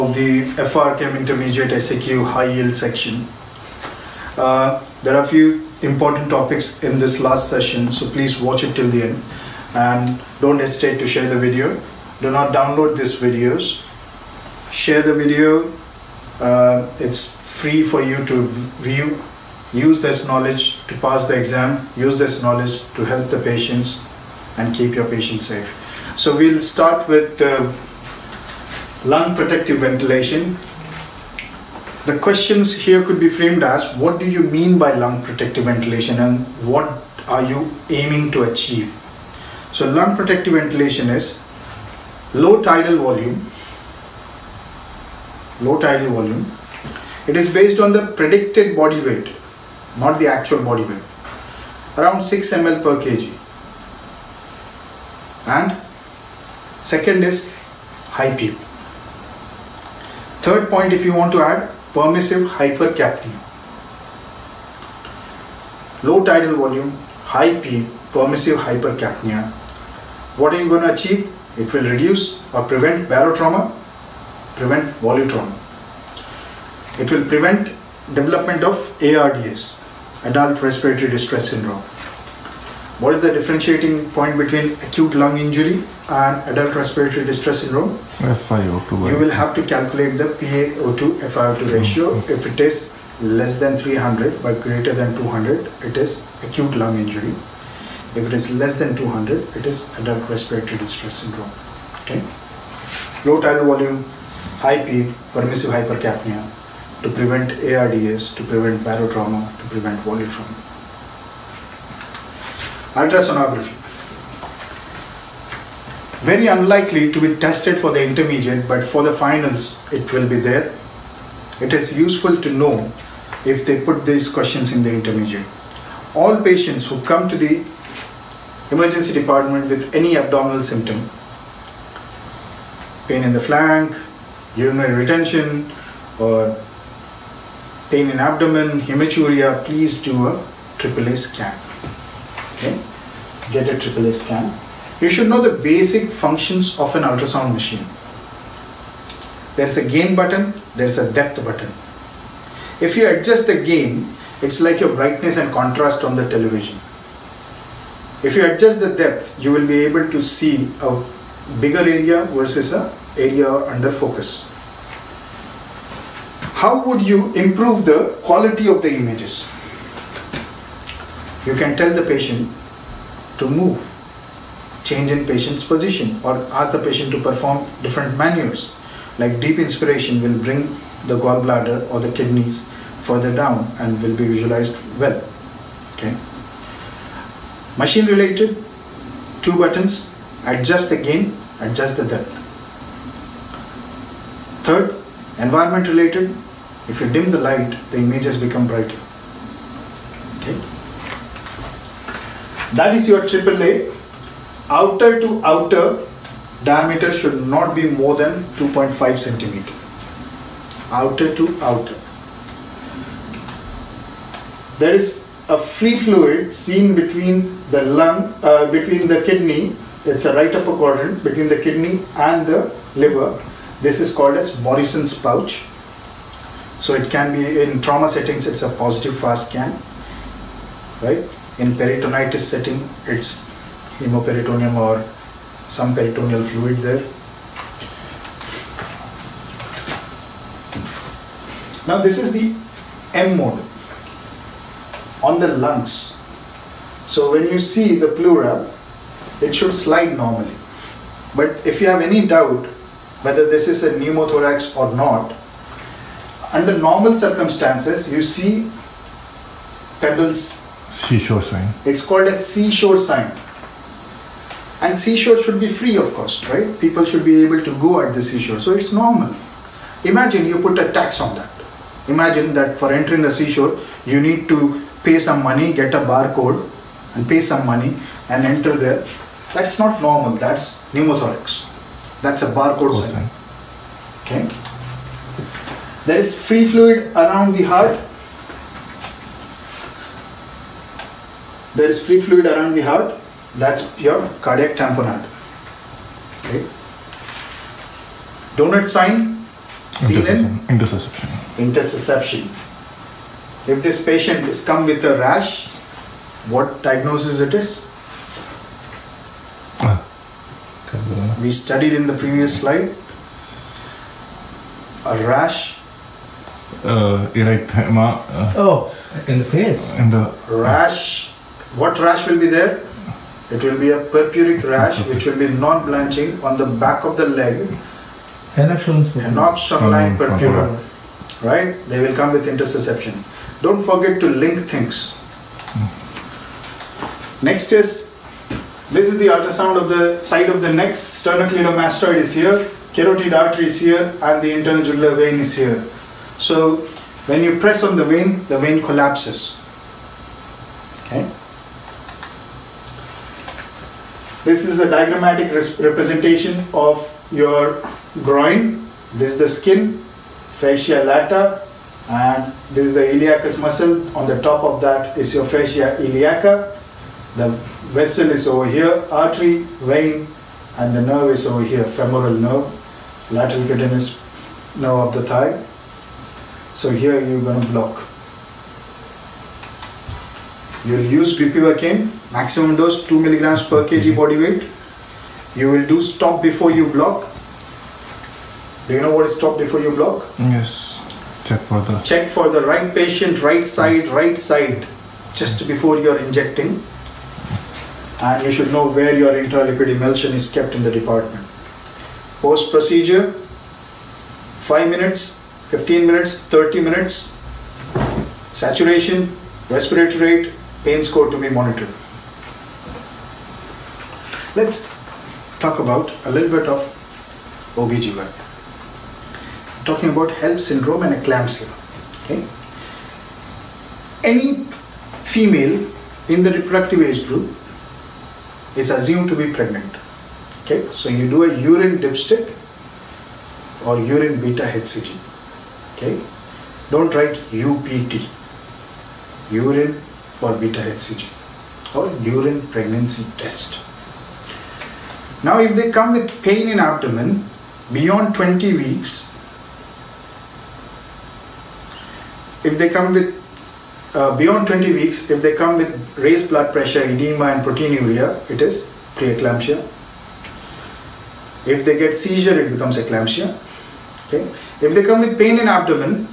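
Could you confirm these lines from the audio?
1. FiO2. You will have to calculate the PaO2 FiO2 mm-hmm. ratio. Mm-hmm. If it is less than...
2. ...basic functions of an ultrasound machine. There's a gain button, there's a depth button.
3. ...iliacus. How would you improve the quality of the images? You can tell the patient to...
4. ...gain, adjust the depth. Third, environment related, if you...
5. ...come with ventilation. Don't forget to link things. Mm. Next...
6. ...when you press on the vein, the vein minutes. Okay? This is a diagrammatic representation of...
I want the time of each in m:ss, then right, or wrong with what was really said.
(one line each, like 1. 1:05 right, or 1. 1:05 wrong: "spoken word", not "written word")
1. 1:28 right
2. 2:25 right
3. 2:43 wrong: "focus", not "iliacus"
4. 3:10 right
5. 5:32 wrong: "intussusception", not "ventilation"
6. 5:47 wrong: "collapses", not "minutes".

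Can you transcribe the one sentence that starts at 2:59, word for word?
Like deep inspiration will bring the gallbladder or the kidneys further down and will be visualized well.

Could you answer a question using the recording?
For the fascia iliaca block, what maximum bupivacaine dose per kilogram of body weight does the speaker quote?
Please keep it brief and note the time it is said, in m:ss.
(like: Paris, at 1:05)
2 mg per kg, at 6:23.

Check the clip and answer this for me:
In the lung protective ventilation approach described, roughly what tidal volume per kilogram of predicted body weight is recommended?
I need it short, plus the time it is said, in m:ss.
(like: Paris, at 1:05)
6 ml per kg, at 0:52.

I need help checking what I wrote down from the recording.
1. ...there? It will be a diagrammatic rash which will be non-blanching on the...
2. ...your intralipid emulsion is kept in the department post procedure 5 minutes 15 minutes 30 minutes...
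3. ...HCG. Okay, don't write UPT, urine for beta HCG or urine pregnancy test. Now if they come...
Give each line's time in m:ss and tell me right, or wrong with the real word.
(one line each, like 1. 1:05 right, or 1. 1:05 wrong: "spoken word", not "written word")
1. 5:22 wrong: "purpuric", not "diagrammatic"
2. 6:39 right
3. 7:14 right.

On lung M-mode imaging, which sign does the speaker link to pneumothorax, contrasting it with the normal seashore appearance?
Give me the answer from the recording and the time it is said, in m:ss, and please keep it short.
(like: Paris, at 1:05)
Barcode sign, at 4:42.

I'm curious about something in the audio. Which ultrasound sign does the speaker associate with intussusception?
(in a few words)
Donut sign.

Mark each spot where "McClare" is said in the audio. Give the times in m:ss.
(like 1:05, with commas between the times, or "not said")
not said.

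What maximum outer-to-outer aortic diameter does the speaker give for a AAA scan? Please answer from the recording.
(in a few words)
2.5 centimeters.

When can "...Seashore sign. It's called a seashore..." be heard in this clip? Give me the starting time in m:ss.
4:20.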